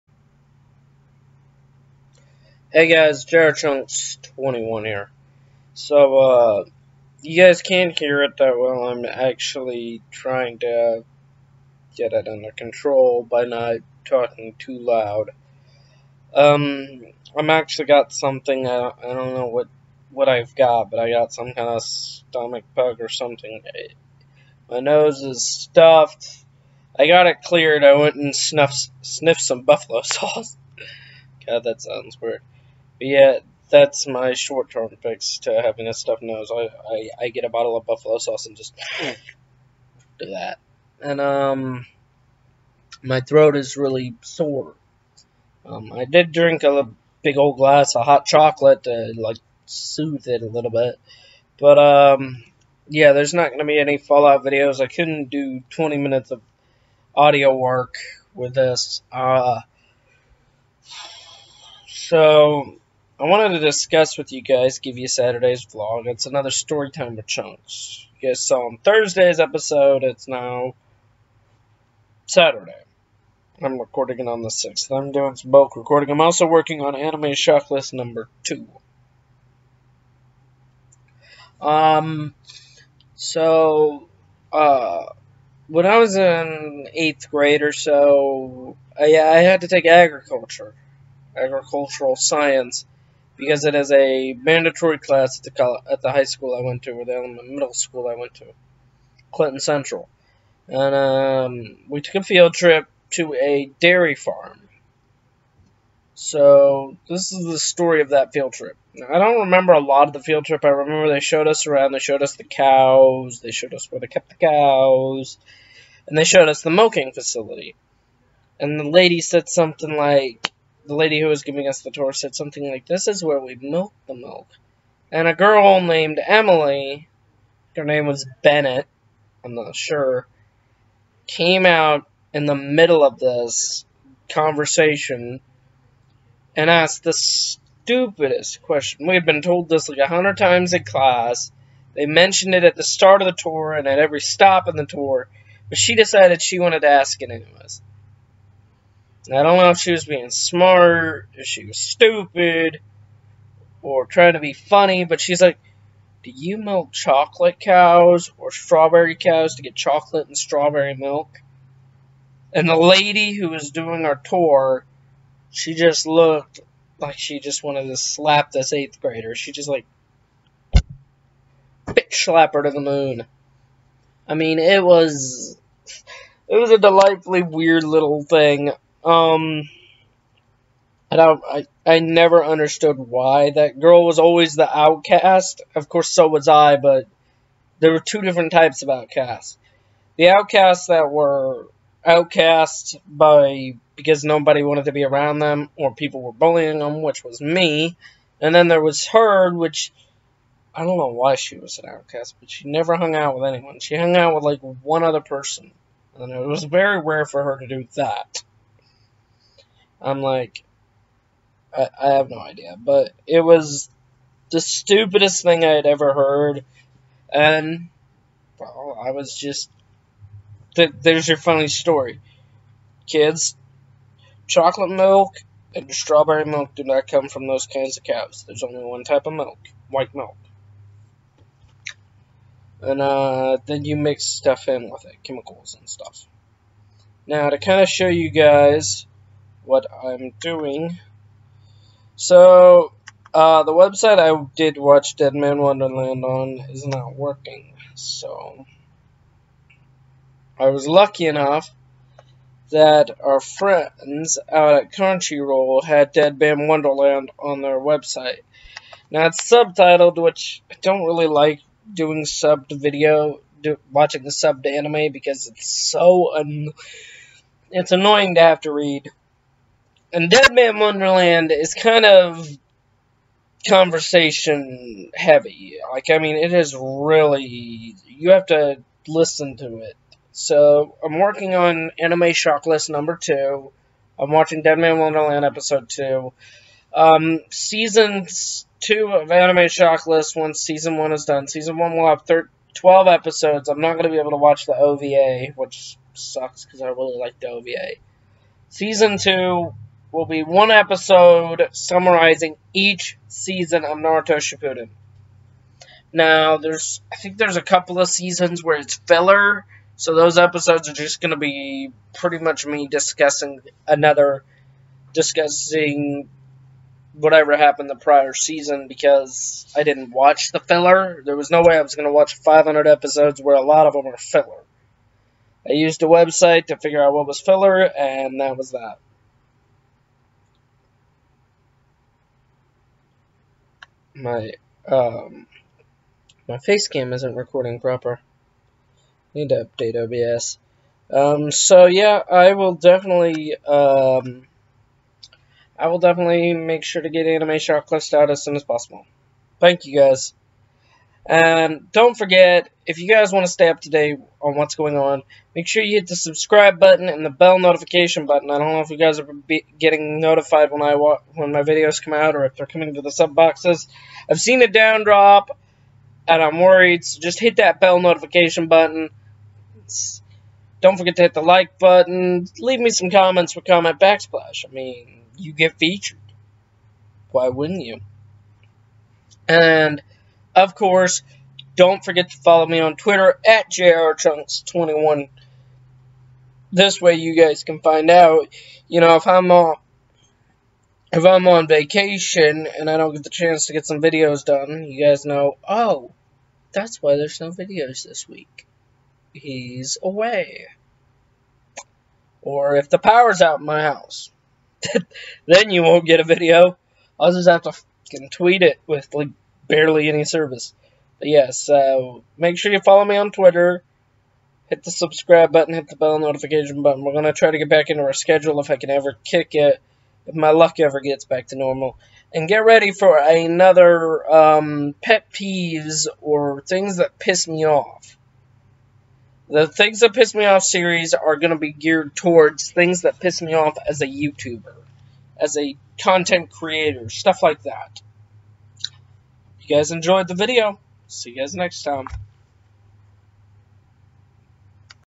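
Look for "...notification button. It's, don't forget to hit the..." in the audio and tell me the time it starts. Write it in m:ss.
6:08.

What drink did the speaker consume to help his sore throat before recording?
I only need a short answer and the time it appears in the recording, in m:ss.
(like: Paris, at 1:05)
Hot chocolate, at 0:48.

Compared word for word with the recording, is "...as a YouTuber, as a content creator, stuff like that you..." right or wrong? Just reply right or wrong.
right.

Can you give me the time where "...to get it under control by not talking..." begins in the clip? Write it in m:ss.
0:10.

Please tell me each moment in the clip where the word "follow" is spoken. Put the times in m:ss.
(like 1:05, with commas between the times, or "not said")
6:22, 6:52.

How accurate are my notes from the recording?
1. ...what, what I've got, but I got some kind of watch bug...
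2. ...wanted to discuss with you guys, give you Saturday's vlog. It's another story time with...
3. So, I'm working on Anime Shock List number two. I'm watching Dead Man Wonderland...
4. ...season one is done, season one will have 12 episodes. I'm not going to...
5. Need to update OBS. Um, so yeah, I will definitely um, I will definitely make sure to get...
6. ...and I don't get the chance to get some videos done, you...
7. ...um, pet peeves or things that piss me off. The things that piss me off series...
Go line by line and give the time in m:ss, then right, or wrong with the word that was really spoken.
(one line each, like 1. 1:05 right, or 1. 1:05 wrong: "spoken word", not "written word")
1. 0:19 wrong: "stomach", not "watch"
2. 1:03 right
3. 4:40 right
4. 4:50 right
5. 5:39 right
6. 6:32 right
7. 7:04 right.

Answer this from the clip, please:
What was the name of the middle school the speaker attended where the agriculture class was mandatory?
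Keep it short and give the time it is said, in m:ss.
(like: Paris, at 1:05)
Clinton Central, at 1:39.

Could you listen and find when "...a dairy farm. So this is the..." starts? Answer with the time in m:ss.
1:43.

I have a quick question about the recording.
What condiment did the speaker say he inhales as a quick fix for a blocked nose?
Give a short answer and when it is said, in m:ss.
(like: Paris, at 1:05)
Buffalo sauce, at 0:37.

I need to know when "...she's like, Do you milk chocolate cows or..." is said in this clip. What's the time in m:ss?
2:35.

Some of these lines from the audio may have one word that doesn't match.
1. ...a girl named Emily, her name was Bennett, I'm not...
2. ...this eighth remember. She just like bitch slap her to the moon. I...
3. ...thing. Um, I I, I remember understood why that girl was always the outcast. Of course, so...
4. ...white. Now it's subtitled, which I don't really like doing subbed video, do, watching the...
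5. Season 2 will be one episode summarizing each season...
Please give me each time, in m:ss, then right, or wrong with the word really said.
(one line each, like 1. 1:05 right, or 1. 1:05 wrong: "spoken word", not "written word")
1. 2:05 right
2. 2:48 wrong: "grader", not "remember"
3. 2:58 wrong: "never", not "remember"
4. 4:17 wrong: "website", not "white"
5. 4:58 right.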